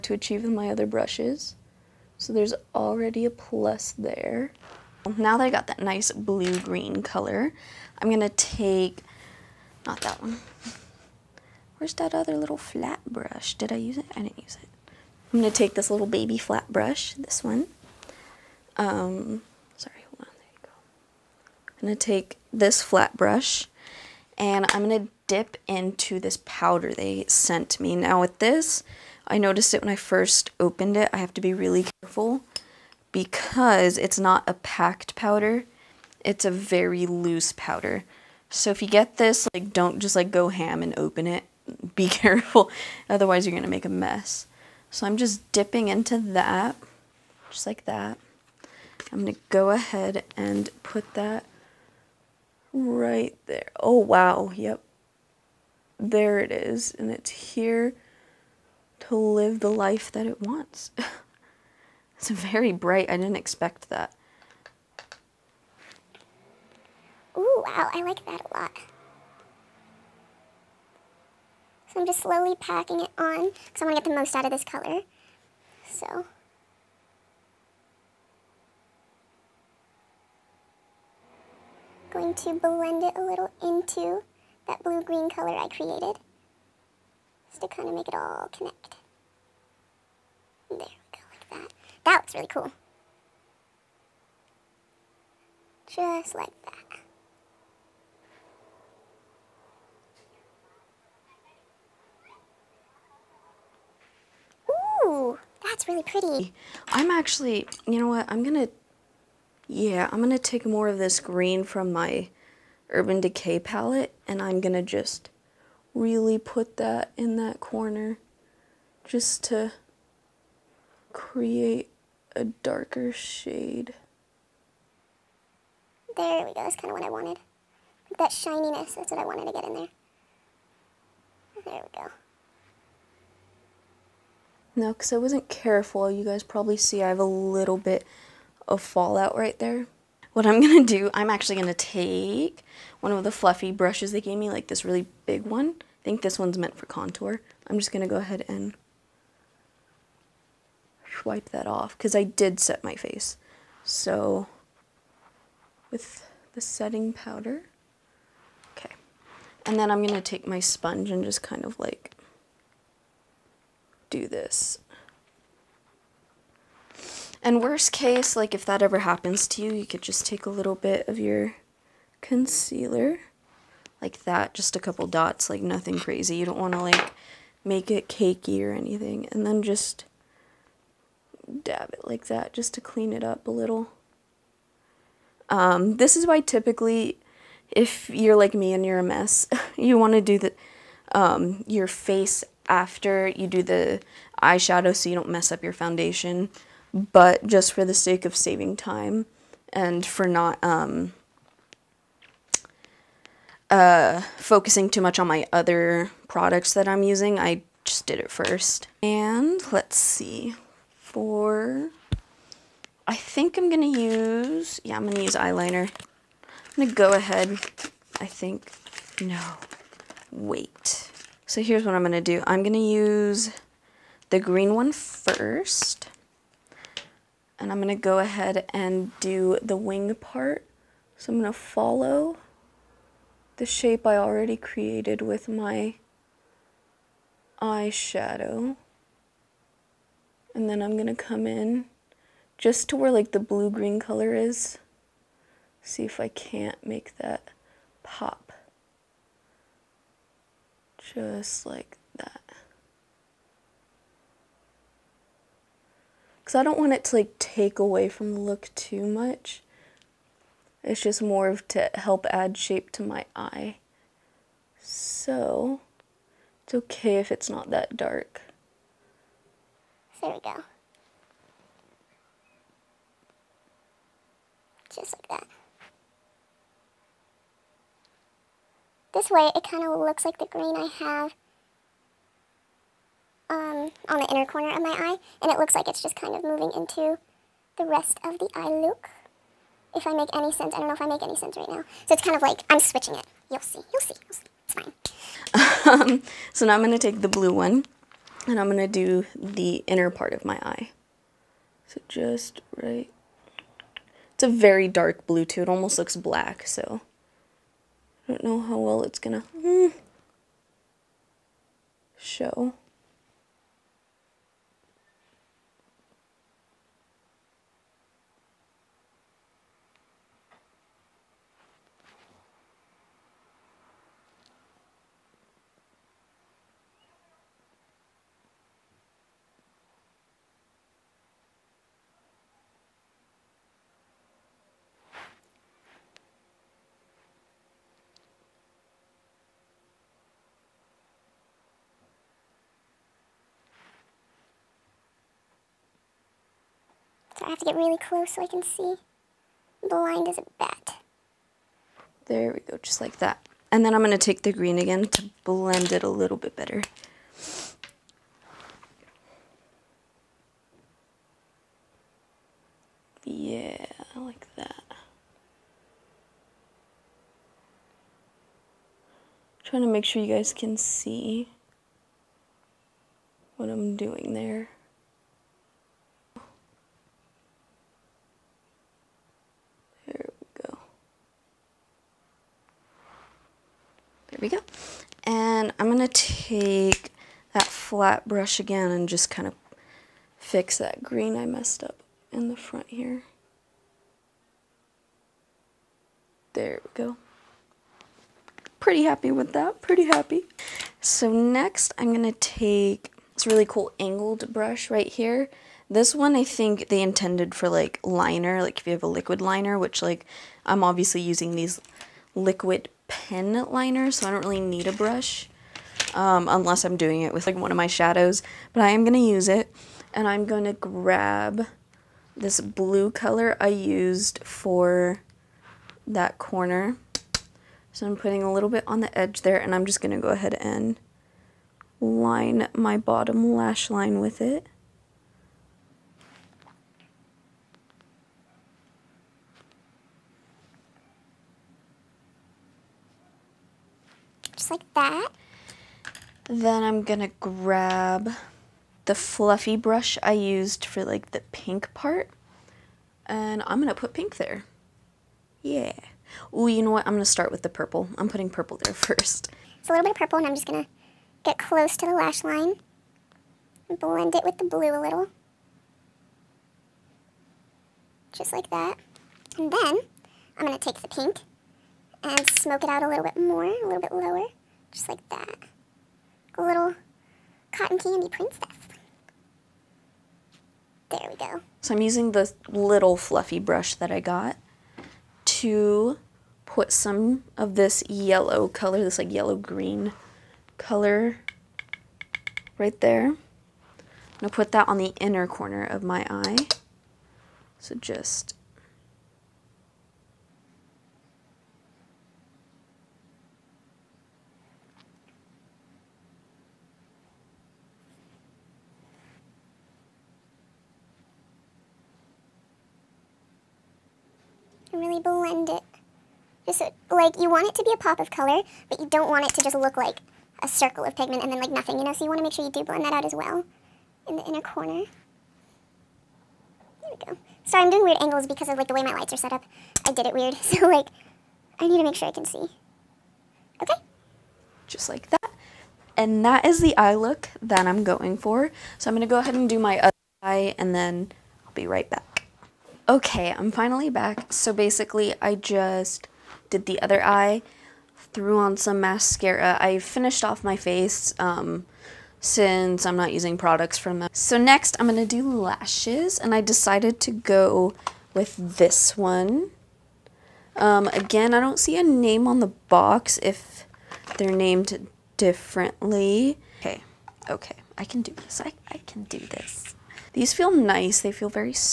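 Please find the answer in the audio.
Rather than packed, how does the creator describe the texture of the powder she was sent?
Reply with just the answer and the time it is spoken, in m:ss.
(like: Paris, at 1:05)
very loose, at 0:36.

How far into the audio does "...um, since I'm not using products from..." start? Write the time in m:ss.
9:11.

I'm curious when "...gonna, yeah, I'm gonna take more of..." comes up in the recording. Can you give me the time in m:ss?
1:48.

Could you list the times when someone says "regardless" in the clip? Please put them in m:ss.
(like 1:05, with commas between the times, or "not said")
not said.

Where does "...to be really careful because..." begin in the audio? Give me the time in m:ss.
0:31.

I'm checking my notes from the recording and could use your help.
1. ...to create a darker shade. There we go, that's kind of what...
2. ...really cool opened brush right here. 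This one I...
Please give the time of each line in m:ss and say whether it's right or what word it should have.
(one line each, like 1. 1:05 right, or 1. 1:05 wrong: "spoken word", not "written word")
1. 1:59 right
2. 6:43 wrong: "angled", not "opened".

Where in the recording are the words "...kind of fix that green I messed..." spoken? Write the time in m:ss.
6:29.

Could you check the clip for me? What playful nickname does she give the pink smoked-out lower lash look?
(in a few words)
cotton candy princess.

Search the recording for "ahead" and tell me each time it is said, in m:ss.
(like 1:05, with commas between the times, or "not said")
0:49, 2:28, 3:37, 3:48, 7:10, 8:59.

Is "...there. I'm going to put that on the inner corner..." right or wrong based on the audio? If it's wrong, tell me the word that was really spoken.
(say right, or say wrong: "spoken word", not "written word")
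right.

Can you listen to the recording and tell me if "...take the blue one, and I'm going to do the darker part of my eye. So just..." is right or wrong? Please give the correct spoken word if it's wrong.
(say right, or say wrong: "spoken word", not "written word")
wrong: "inner", not "darker".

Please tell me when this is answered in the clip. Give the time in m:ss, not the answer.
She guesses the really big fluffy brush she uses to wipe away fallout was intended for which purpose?
2:26.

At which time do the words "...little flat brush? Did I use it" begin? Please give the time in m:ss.
0:12.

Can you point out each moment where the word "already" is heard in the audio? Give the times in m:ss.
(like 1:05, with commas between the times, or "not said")
0:02, 3:54.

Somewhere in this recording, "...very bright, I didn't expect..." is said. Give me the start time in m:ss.
1:02.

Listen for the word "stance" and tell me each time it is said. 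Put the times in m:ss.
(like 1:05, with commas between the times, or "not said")
not said.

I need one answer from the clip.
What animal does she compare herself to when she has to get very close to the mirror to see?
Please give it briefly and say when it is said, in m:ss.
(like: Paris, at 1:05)
a bat, at 5:49.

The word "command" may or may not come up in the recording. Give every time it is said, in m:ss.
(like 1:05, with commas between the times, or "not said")
not said.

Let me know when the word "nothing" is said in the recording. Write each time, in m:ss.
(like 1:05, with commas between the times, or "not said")
2:55, 8:41.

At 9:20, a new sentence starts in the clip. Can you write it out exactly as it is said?
Um, again, I don't see a name on the box if they're named differently.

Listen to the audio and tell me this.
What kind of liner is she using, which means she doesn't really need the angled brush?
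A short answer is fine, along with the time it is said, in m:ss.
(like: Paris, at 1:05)
liquid pen liner, at 6:52.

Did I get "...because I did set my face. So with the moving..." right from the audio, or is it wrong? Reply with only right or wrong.
wrong.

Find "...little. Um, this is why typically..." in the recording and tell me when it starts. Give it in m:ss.
3:03.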